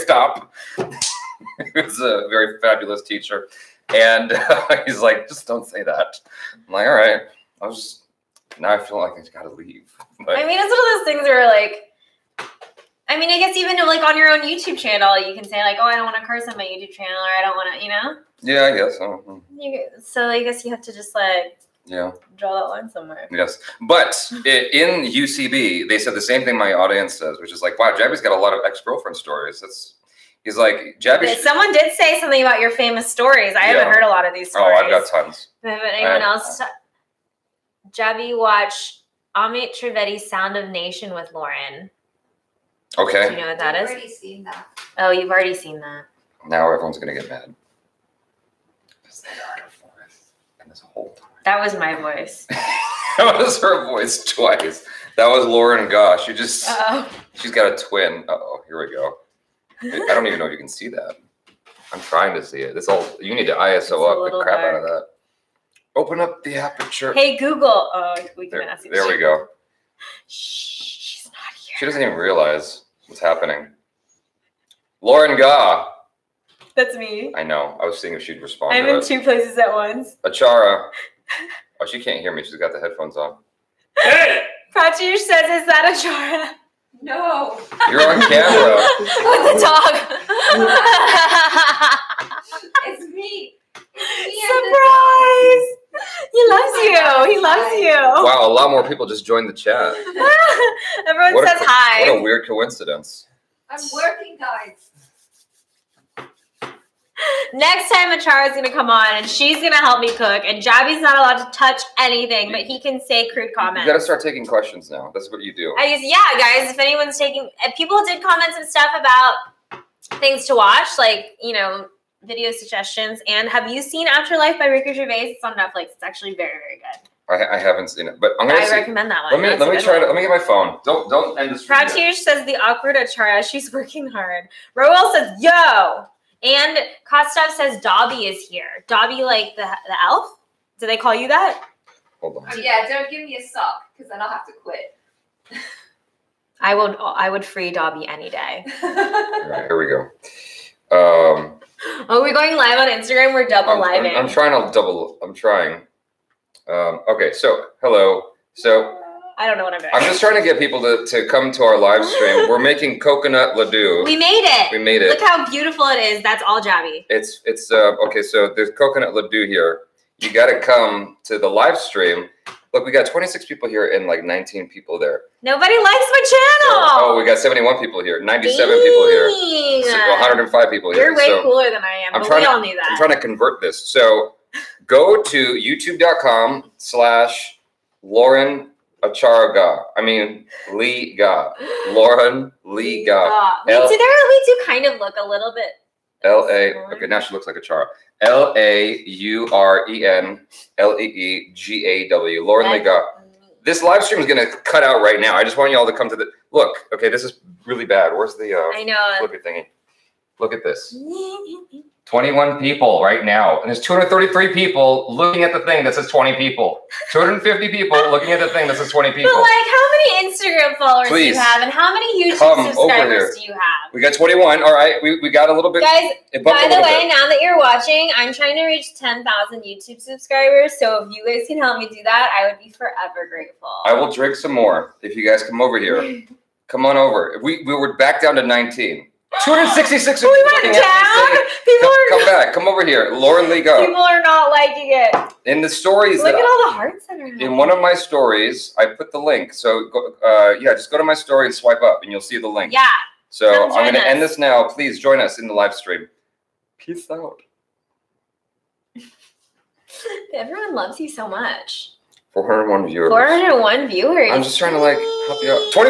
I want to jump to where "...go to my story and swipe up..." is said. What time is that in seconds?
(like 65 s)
250 s.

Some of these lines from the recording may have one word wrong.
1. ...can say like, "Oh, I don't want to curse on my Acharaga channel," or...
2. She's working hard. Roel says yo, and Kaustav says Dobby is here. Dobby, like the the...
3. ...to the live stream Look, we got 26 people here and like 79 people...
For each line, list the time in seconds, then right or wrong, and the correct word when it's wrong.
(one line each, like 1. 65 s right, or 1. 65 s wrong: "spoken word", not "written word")
1. 15 s wrong: "YouTube", not "Acharaga"
2. 133 s right
3. 171 s wrong: "19", not "79".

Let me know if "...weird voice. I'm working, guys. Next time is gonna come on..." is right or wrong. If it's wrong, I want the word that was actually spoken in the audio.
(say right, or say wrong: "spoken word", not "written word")
wrong: "coincidence", not "voice".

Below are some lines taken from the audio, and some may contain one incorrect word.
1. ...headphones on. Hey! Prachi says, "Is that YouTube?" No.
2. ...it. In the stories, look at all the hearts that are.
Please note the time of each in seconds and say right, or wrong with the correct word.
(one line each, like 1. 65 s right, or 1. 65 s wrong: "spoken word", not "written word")
1. 82 s wrong: "Achara", not "YouTube"
2. 244 s right.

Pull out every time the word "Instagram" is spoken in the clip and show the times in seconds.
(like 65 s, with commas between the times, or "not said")
152 s, 220 s.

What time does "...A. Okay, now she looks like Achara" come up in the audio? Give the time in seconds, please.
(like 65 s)
196 s.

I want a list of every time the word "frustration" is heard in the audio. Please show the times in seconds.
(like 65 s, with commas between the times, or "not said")
not said.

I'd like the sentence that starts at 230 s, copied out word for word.
So if you guys can help me do that, I would be forever grateful.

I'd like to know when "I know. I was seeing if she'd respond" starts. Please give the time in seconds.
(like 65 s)
77 s.